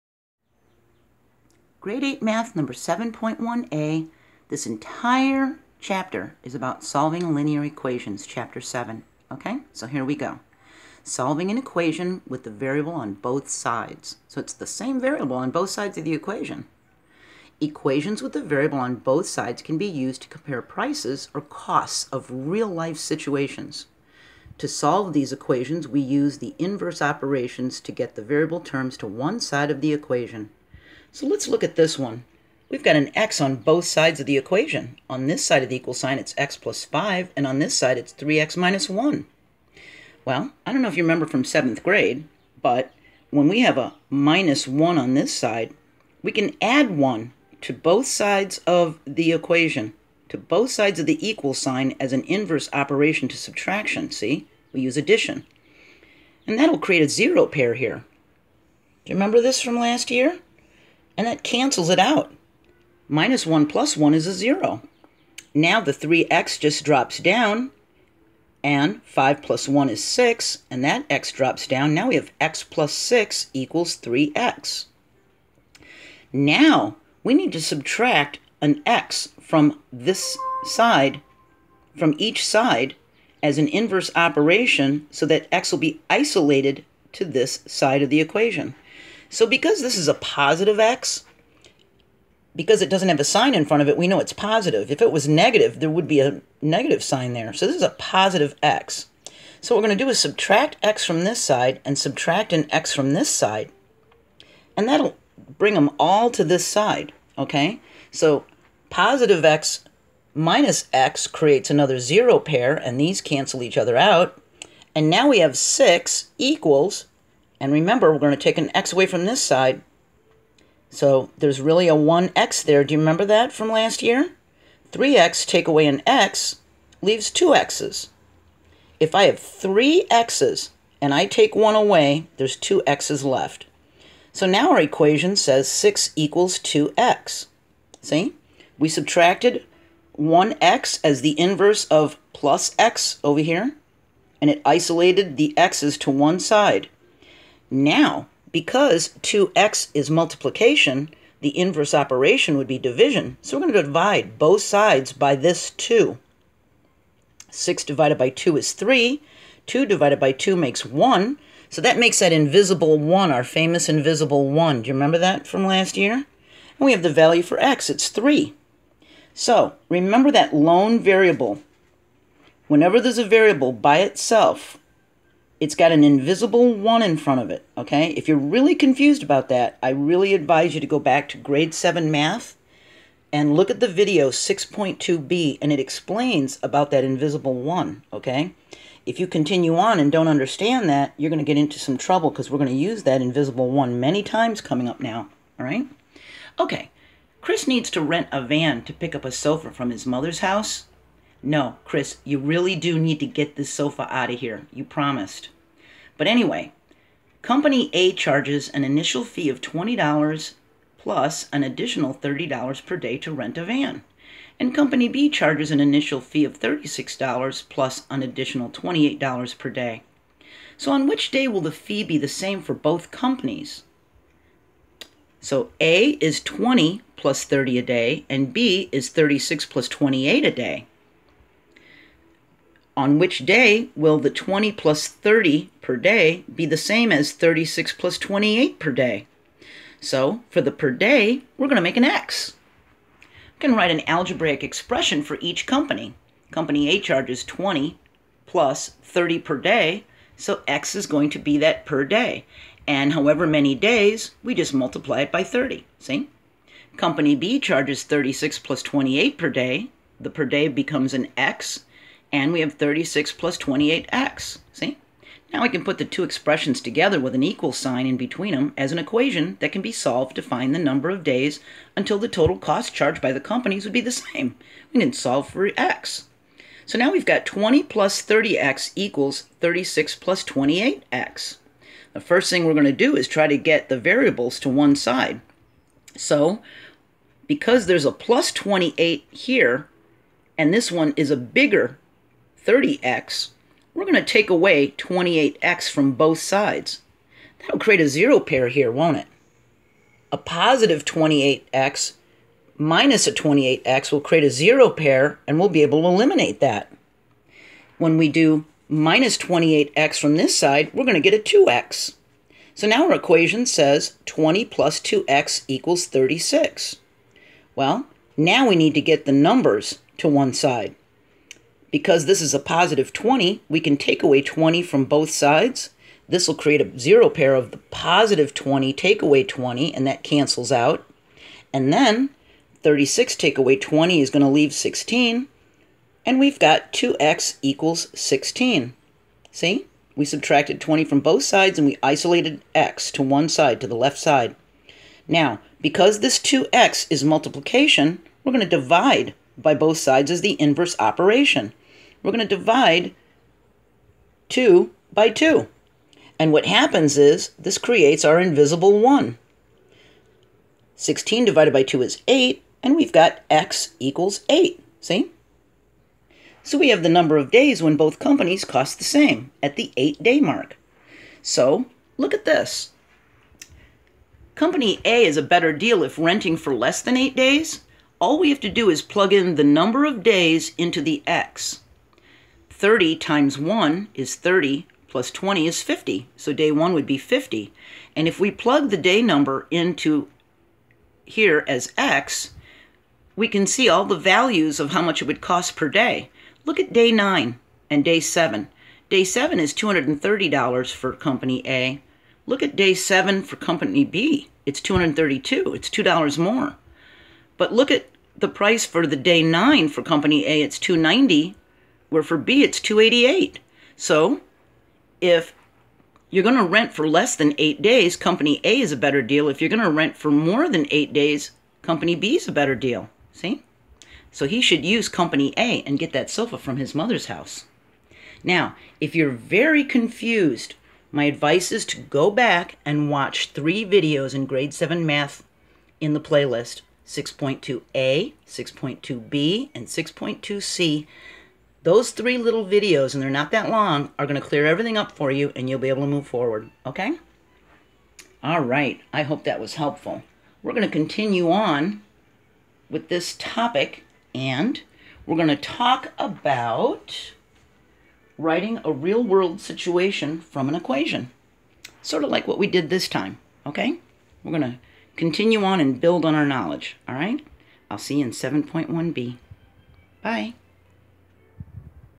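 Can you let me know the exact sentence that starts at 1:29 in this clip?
So because this is a positive x, because it doesn't have a sign in front of it, we know it's positive.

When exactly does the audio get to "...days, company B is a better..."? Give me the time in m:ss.
7:01.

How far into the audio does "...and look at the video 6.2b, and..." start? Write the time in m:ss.
3:03.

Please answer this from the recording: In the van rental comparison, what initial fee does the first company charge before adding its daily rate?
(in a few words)
$20.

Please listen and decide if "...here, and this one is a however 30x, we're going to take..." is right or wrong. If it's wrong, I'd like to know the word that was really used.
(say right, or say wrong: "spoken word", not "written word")
wrong: "bigger", not "however".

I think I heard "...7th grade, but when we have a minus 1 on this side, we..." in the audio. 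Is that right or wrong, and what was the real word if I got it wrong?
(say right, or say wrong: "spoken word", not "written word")
right.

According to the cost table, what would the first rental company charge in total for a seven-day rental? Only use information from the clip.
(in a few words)
$230.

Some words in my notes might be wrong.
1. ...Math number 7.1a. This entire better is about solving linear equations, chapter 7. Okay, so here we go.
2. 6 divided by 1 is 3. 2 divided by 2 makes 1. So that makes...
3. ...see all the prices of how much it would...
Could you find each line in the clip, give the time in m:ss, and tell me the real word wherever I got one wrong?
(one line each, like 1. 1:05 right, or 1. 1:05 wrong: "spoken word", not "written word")
1. 0:02 wrong: "chapter", not "better"
2. 2:37 wrong: "2", not "1"
3. 6:33 wrong: "values", not "prices".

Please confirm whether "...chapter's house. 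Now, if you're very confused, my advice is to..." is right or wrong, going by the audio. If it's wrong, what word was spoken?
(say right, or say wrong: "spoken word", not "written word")
wrong: "mother", not "chapter".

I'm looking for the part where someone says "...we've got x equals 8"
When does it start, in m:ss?
6:02.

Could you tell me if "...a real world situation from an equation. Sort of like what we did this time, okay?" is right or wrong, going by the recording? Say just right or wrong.
right.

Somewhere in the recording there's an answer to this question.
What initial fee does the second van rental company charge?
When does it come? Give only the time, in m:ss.
3:35.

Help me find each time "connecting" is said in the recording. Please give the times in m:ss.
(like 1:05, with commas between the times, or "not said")
not said.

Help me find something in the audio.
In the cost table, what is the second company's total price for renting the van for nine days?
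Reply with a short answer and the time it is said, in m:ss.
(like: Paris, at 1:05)
$288, at 6:52.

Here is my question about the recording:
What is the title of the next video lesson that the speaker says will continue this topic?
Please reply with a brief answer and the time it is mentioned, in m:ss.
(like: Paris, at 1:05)
7.1b, at 7:48.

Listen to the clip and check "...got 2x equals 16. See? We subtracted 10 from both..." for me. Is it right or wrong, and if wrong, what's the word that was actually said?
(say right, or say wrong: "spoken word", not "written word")
wrong: "20", not "10".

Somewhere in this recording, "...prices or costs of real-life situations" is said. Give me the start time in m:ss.
0:20.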